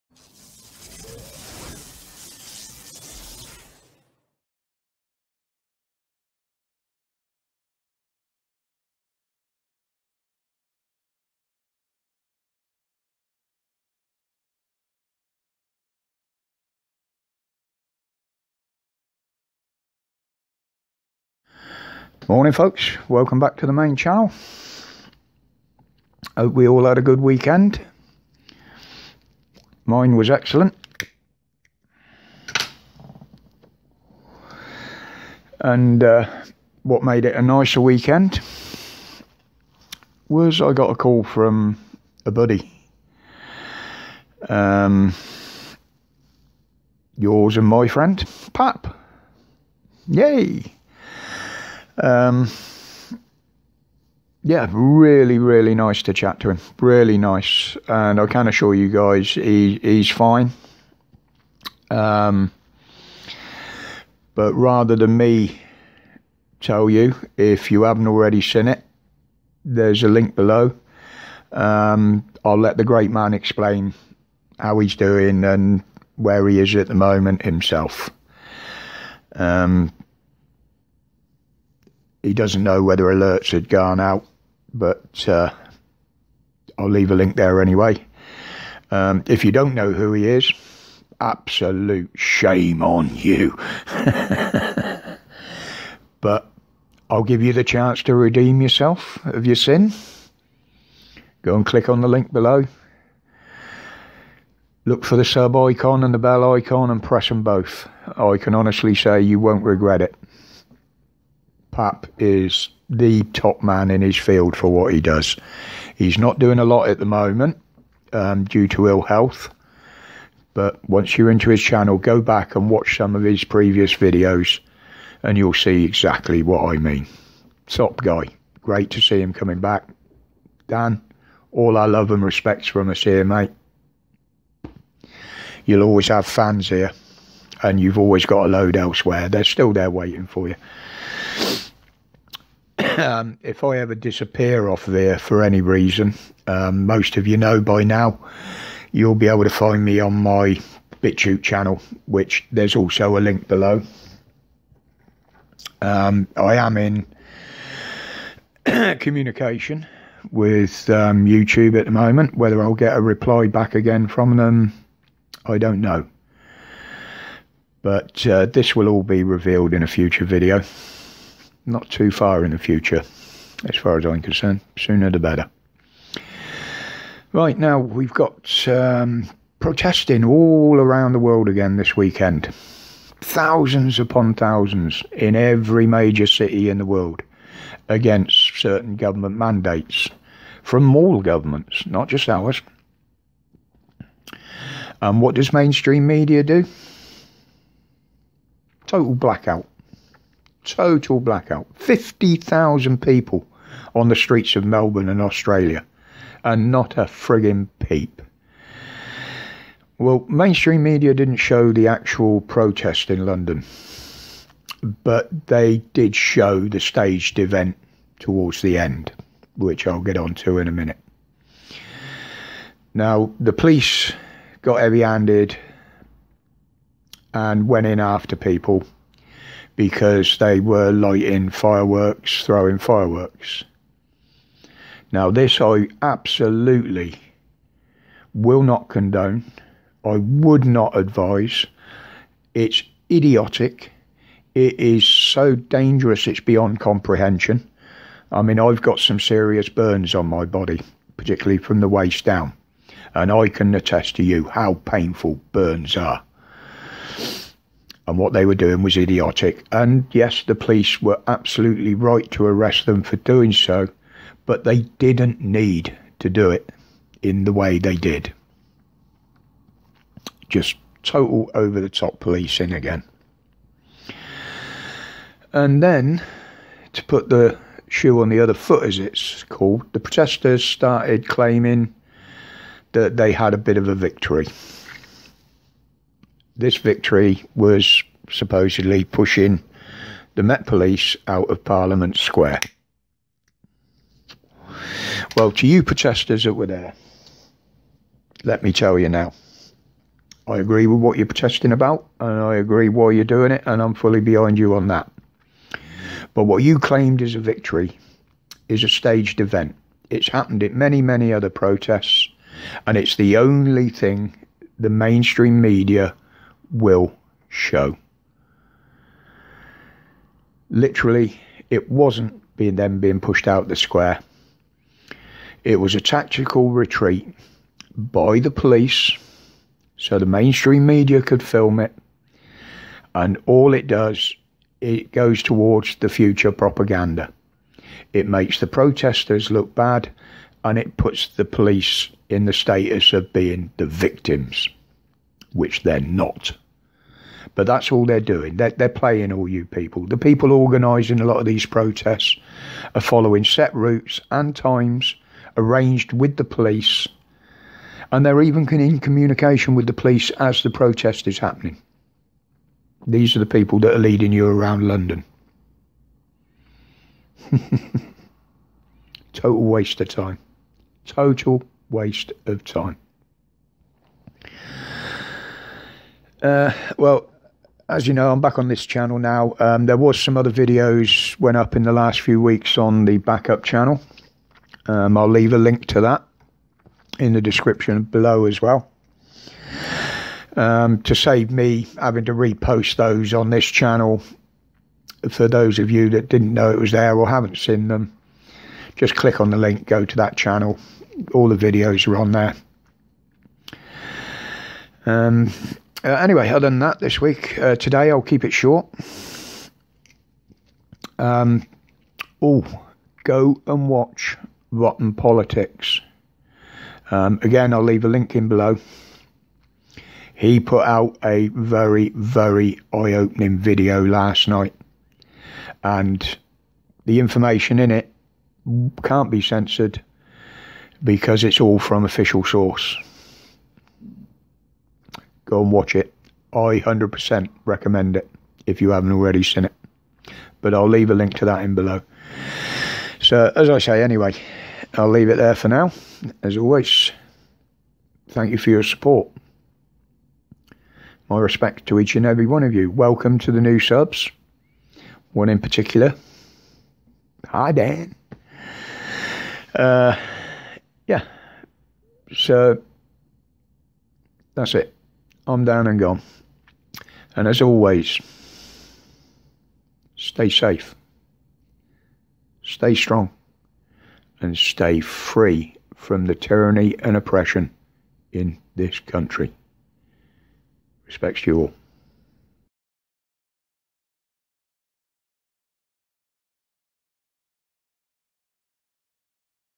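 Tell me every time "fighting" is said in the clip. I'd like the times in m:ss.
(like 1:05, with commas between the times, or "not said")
not said.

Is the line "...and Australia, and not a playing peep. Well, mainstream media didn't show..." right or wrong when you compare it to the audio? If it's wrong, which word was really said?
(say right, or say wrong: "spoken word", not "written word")
wrong: "frigging", not "playing".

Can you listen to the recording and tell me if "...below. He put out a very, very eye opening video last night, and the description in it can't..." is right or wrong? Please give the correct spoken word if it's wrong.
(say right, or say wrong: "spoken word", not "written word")
wrong: "information", not "description".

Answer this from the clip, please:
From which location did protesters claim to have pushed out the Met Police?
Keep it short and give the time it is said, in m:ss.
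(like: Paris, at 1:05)
Parliament Square, at 4:51.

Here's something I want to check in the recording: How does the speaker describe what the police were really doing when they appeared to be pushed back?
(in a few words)
Tactical retreat.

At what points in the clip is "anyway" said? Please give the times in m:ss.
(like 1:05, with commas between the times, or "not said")
1:27, 6:46, 7:24.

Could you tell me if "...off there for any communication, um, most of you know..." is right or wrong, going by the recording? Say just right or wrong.
wrong.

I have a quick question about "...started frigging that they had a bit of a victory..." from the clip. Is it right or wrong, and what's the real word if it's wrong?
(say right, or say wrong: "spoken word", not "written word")
wrong: "claiming", not "frigging".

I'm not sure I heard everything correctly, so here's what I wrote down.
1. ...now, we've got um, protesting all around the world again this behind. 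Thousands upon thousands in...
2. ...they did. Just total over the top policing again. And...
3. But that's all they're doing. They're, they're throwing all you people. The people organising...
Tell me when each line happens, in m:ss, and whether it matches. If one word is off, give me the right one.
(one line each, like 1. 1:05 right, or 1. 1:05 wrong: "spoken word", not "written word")
1. 2:57 wrong: "weekend", not "behind"
2. 4:27 right
3. 5:47 wrong: "playing", not "throwing".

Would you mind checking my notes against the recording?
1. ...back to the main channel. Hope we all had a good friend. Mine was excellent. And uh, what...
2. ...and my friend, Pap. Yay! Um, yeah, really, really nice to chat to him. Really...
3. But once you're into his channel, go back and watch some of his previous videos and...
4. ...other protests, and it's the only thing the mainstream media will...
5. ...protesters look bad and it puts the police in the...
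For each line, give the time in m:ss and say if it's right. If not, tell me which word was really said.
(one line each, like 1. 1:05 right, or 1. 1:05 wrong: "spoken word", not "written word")
1. 0:23 wrong: "weekend", not "friend"
2. 0:47 right
3. 2:00 right
4. 5:11 right
5. 5:38 right.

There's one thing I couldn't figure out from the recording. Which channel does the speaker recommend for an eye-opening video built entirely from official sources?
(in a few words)
Rotten Politics.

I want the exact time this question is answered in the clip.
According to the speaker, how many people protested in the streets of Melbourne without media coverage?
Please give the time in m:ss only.
3:21.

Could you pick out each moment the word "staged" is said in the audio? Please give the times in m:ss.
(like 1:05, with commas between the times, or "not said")
3:36, 5:08.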